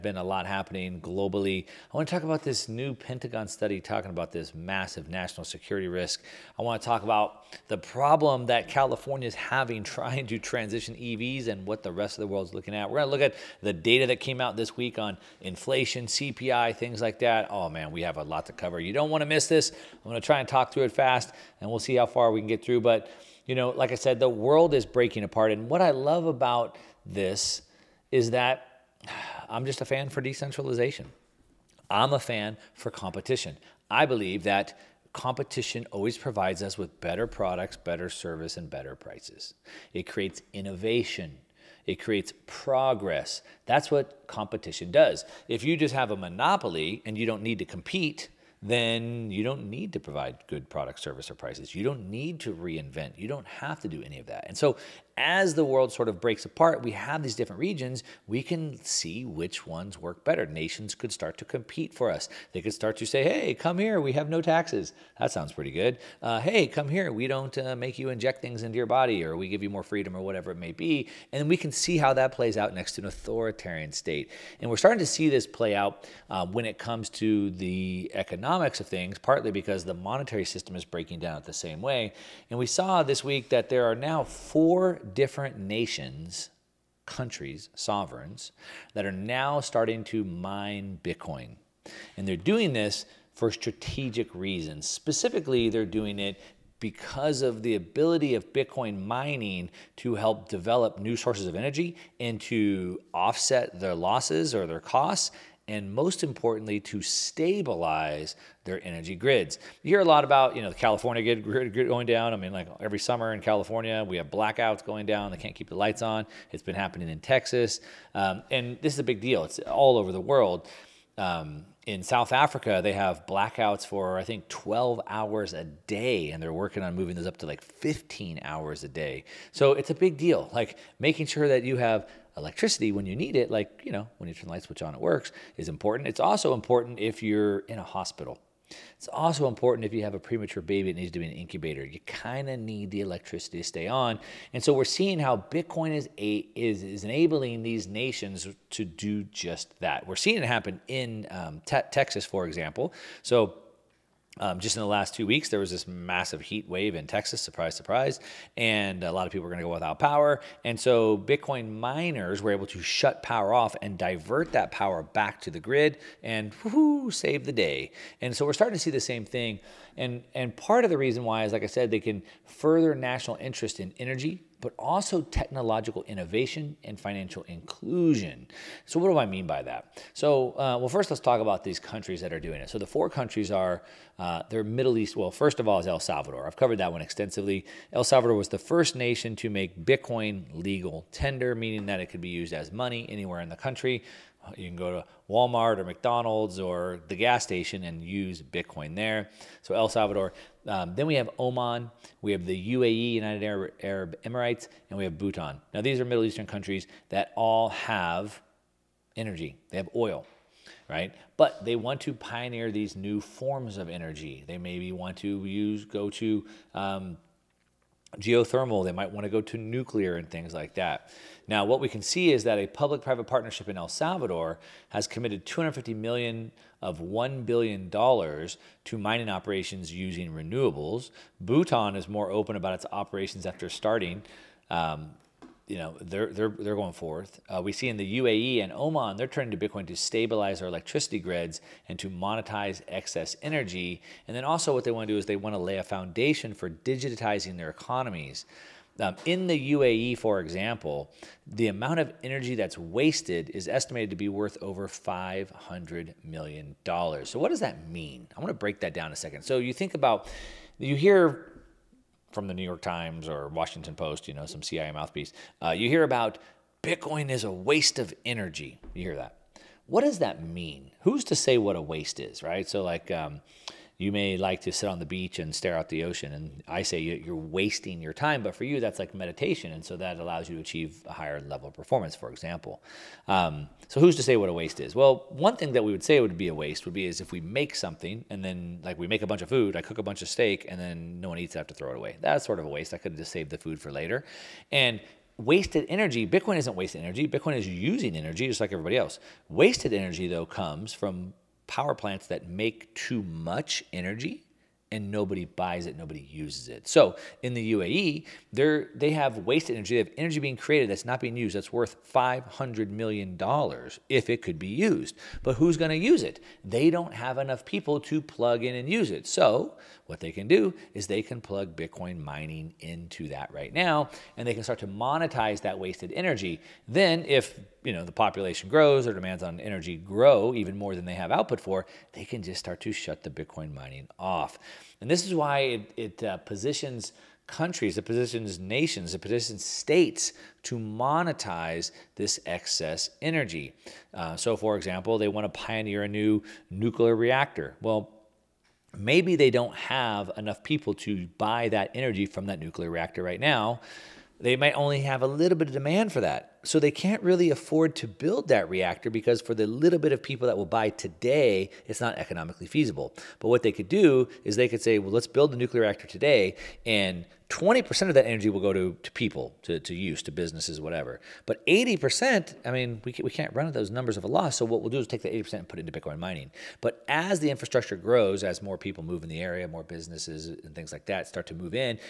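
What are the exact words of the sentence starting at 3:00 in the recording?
So, uh, well, first let's talk about these countries that are doing it.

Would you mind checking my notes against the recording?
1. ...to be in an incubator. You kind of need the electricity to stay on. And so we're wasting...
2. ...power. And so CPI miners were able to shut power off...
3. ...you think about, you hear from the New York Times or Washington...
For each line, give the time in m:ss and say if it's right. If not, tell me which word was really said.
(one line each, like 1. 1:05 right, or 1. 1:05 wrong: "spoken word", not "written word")
1. 2:21 wrong: "seeing", not "wasting"
2. 2:39 wrong: "Bitcoin", not "CPI"
3. 4:19 right.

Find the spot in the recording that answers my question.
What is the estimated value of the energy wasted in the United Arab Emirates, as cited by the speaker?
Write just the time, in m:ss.
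4:14.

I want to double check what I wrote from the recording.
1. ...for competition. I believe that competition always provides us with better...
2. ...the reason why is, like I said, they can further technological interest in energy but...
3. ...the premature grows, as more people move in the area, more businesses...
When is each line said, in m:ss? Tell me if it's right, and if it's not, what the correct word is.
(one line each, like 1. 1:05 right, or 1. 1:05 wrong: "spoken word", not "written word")
1. 0:32 right
2. 2:50 wrong: "national", not "technological"
3. 6:17 wrong: "infrastructure", not "premature".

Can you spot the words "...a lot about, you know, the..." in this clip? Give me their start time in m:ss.
1:49.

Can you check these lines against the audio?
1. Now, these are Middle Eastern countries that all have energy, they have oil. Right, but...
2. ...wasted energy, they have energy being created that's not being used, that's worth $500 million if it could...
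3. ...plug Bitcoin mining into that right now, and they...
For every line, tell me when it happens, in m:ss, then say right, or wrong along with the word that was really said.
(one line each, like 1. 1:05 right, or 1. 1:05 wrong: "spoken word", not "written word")
1. 3:25 right
2. 5:09 right
3. 5:21 right.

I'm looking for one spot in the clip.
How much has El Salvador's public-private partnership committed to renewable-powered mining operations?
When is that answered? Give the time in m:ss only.
3:45.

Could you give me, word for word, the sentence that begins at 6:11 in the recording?
But 80%, I mean, we, can, we can't run at those numbers of a loss.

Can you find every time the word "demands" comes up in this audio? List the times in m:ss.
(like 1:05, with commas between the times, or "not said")
5:29, 5:55.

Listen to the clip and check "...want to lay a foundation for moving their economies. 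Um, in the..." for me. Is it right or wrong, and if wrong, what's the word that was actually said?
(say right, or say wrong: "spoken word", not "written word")
wrong: "digitizing", not "moving".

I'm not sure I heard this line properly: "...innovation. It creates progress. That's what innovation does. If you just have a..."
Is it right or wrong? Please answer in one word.
wrong.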